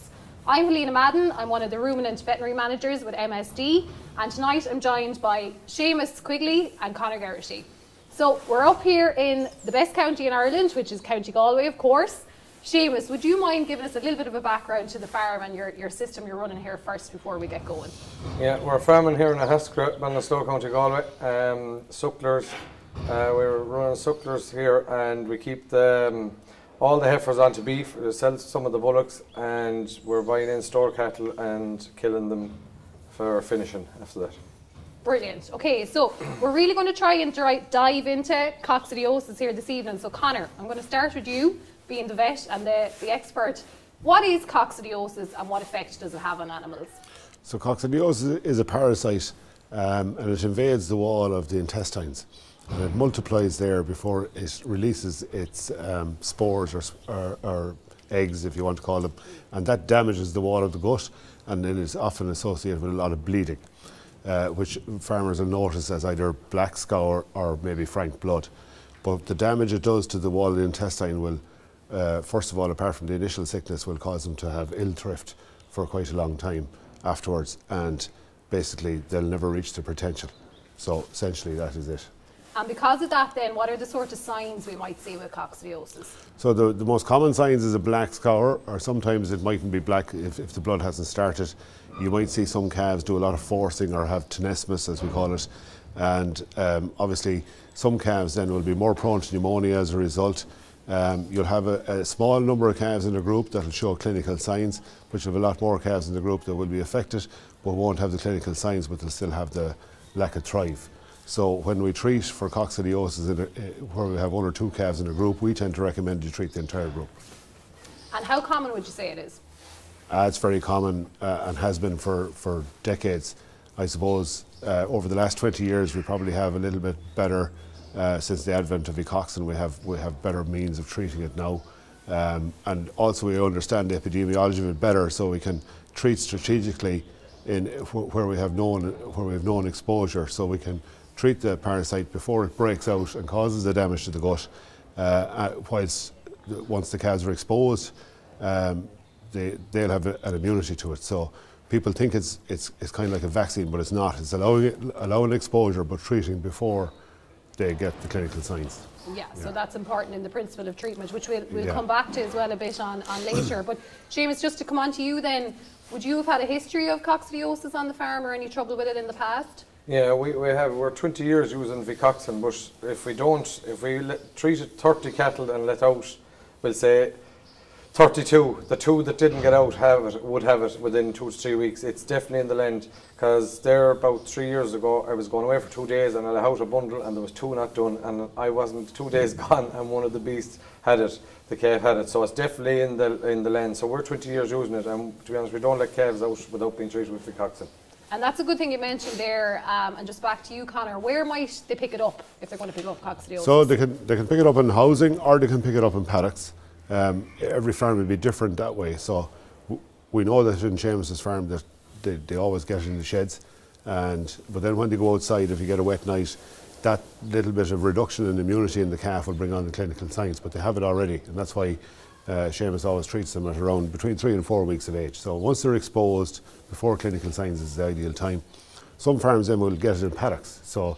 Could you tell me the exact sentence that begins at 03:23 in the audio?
So they can, they can pick it up in housing or they can pick it up in paddocks.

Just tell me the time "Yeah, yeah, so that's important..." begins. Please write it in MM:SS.
02:39.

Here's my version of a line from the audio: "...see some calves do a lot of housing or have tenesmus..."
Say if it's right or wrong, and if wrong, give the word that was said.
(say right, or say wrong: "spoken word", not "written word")
wrong: "forcing", not "housing".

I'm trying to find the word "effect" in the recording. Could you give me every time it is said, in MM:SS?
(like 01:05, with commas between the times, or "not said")
00:45.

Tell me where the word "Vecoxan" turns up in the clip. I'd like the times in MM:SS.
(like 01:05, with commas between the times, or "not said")
02:08, 02:51, 03:17.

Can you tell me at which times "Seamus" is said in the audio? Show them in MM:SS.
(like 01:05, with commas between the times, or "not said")
00:05, 00:12, 02:44, 03:30, 03:42.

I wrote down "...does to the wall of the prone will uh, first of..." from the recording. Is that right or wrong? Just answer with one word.
wrong.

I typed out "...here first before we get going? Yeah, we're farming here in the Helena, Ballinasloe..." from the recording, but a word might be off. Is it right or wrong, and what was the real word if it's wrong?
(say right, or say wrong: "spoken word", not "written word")
wrong: "Haskra", not "Helena".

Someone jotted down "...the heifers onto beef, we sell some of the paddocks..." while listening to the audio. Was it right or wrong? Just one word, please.
wrong.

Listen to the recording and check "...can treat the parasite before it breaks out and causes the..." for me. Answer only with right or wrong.
right.